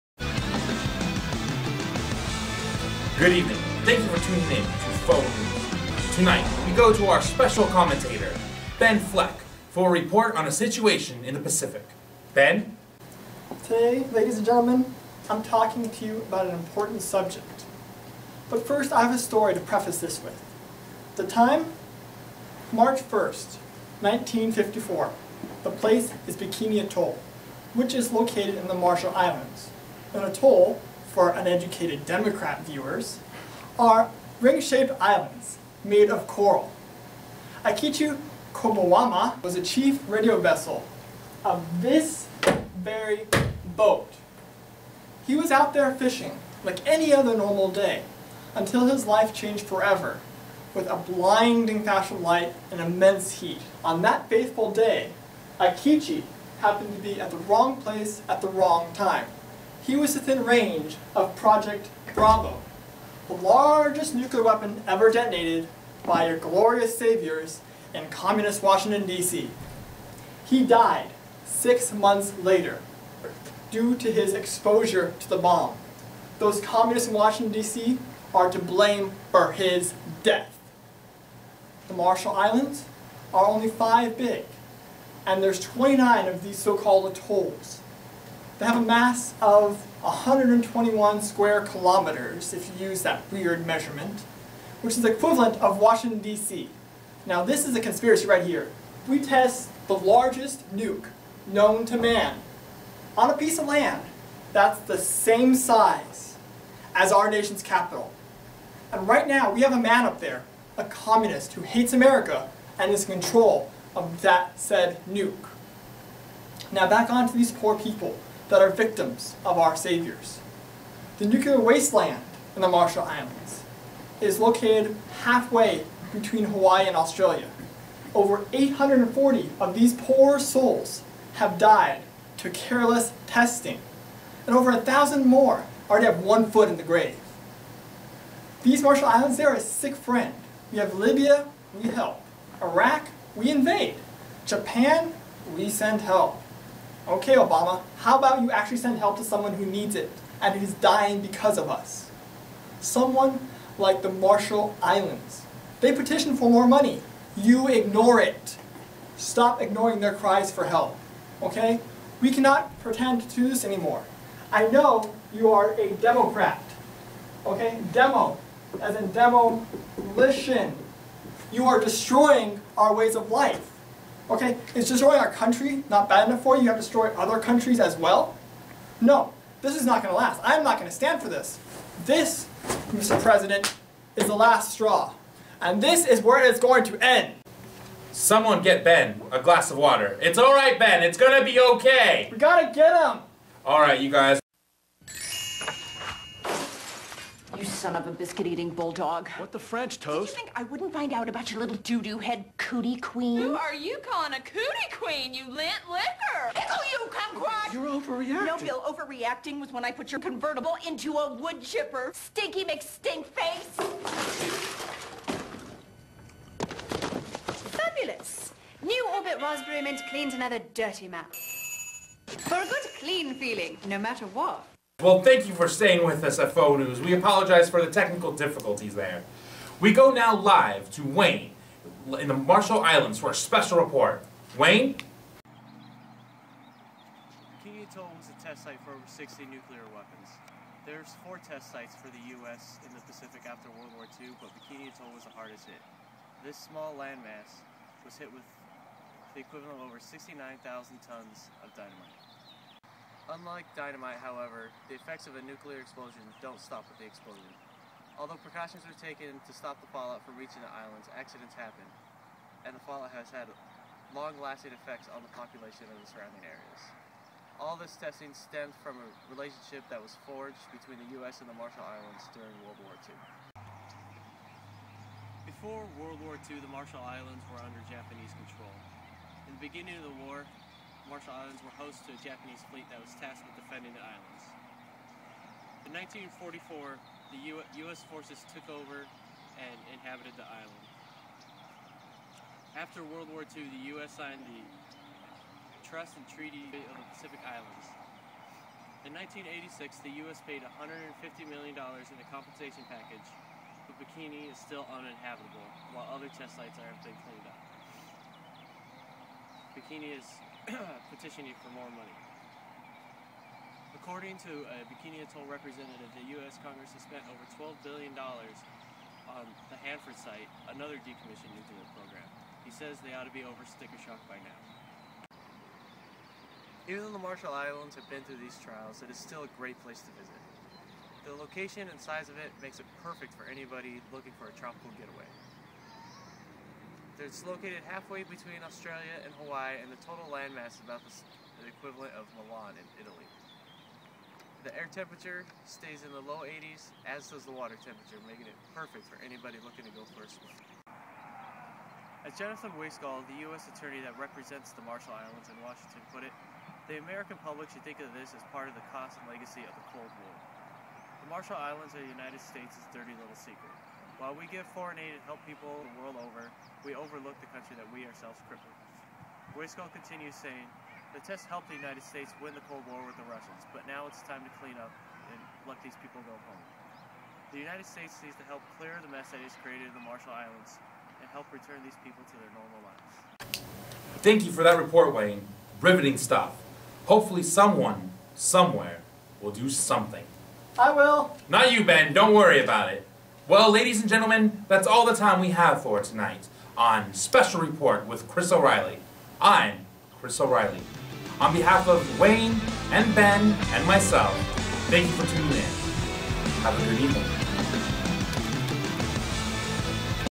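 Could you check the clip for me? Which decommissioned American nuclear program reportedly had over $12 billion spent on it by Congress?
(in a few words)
Hanford site.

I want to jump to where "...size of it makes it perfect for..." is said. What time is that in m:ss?
5:32.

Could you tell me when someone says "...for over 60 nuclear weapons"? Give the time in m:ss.
3:58.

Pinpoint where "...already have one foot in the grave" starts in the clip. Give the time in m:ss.
2:15.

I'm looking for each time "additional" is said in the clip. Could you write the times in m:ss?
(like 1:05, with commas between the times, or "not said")
not said.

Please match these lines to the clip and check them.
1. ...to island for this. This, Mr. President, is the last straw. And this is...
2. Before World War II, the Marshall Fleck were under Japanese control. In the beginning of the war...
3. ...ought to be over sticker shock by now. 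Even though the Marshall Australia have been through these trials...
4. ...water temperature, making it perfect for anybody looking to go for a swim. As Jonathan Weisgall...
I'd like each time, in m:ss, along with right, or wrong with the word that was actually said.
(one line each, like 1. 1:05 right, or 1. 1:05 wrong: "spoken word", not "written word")
1. 3:00 wrong: "stand", not "island"
2. 4:35 wrong: "Islands", not "Fleck"
3. 5:23 wrong: "Islands", not "Australia"
4. 5:47 right.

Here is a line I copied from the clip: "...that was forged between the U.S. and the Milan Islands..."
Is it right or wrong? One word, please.
wrong.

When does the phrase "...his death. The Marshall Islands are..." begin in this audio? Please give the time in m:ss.
1:19.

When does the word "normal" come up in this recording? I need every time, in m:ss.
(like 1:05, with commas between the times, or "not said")
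0:47, 6:22.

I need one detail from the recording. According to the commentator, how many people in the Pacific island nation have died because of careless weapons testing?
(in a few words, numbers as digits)
840.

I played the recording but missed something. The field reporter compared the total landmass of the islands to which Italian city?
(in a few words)
Milan.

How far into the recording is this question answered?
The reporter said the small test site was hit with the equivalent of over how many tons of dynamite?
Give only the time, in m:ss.
4:09.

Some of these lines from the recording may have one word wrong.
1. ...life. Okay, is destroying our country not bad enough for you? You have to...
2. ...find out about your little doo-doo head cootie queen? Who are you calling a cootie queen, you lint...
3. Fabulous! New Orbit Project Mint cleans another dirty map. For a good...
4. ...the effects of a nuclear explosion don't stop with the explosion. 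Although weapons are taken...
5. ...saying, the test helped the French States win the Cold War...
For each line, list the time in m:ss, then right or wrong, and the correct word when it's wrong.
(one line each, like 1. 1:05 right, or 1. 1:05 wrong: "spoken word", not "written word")
1. 2:53 right
2. 3:20 right
3. 3:37 wrong: "Raspberry", not "Project"
4. 4:14 wrong: "precautions", not "weapons"
5. 6:10 wrong: "United", not "French".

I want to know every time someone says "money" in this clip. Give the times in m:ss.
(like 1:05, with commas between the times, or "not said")
2:36, 5:11.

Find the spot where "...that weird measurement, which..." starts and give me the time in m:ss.
1:33.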